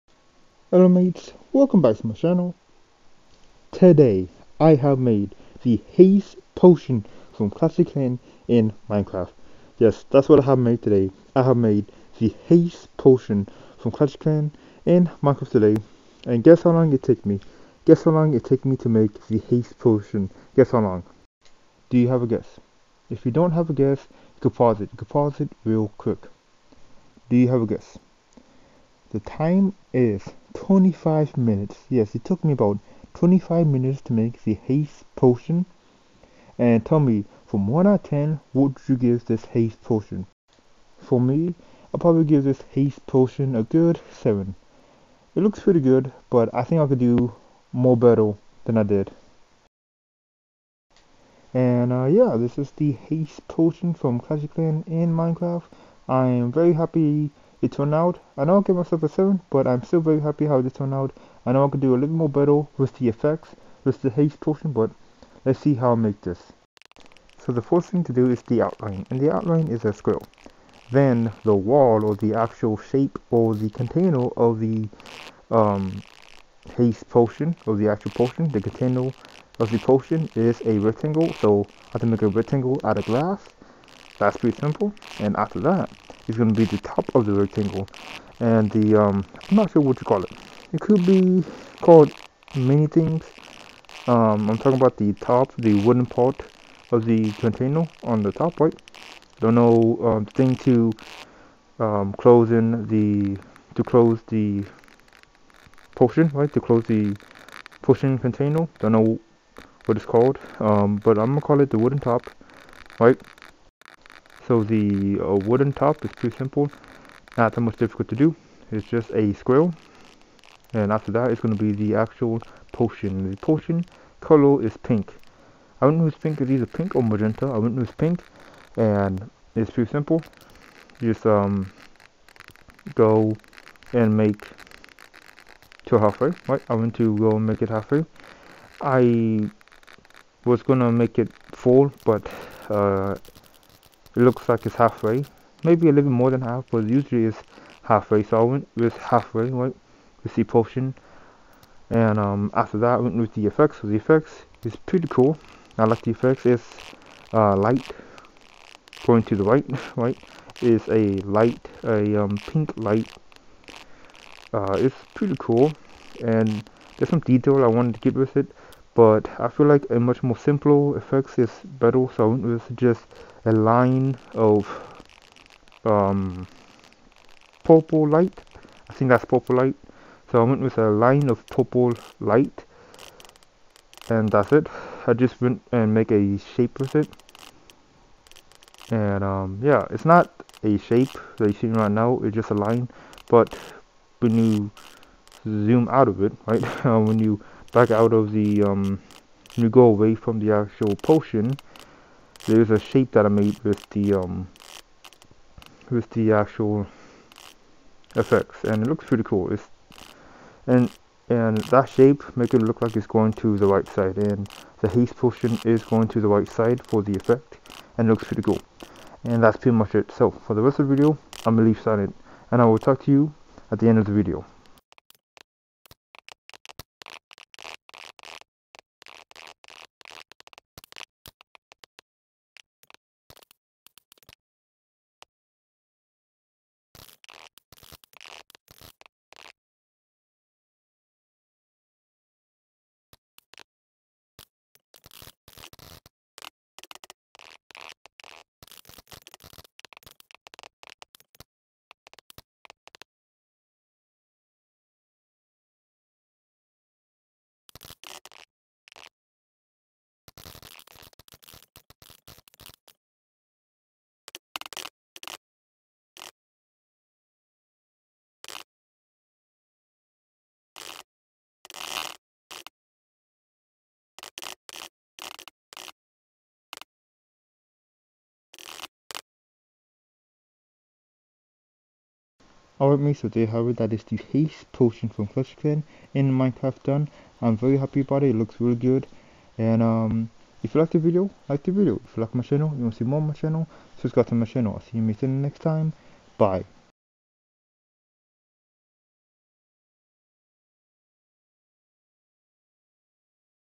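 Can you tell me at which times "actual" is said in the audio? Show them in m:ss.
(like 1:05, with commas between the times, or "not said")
1:12, 1:17, 2:01, 3:20, 3:26.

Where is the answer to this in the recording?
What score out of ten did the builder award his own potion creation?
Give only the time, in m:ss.
0:43.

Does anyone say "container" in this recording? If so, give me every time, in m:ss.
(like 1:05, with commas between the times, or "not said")
1:13, 1:18, 1:37, 1:48.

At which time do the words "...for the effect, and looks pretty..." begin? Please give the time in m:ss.
3:36.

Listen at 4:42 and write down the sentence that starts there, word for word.
Alright mates, so there however that is the haste potion from Clutch Clan in Minecraft done.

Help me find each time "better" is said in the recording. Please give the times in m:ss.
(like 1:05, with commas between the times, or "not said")
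0:47, 1:02, 2:51.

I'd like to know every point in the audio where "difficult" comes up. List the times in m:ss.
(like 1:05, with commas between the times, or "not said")
1:57.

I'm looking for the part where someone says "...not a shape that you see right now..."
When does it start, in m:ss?
3:10.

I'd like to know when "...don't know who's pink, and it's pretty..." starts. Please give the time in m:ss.
2:07.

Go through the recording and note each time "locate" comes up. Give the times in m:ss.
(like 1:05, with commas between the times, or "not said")
not said.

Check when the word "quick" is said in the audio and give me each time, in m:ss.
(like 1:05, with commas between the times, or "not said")
0:25.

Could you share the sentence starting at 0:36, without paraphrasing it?
And tell me, from 1 out of 10, would you give this haste potion?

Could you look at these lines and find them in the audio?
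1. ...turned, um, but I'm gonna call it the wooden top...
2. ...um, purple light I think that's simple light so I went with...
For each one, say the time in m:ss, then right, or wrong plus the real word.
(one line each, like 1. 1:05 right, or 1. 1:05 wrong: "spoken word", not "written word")
1. 1:50 wrong: "called", not "turned"
2. 2:55 wrong: "purple", not "simple".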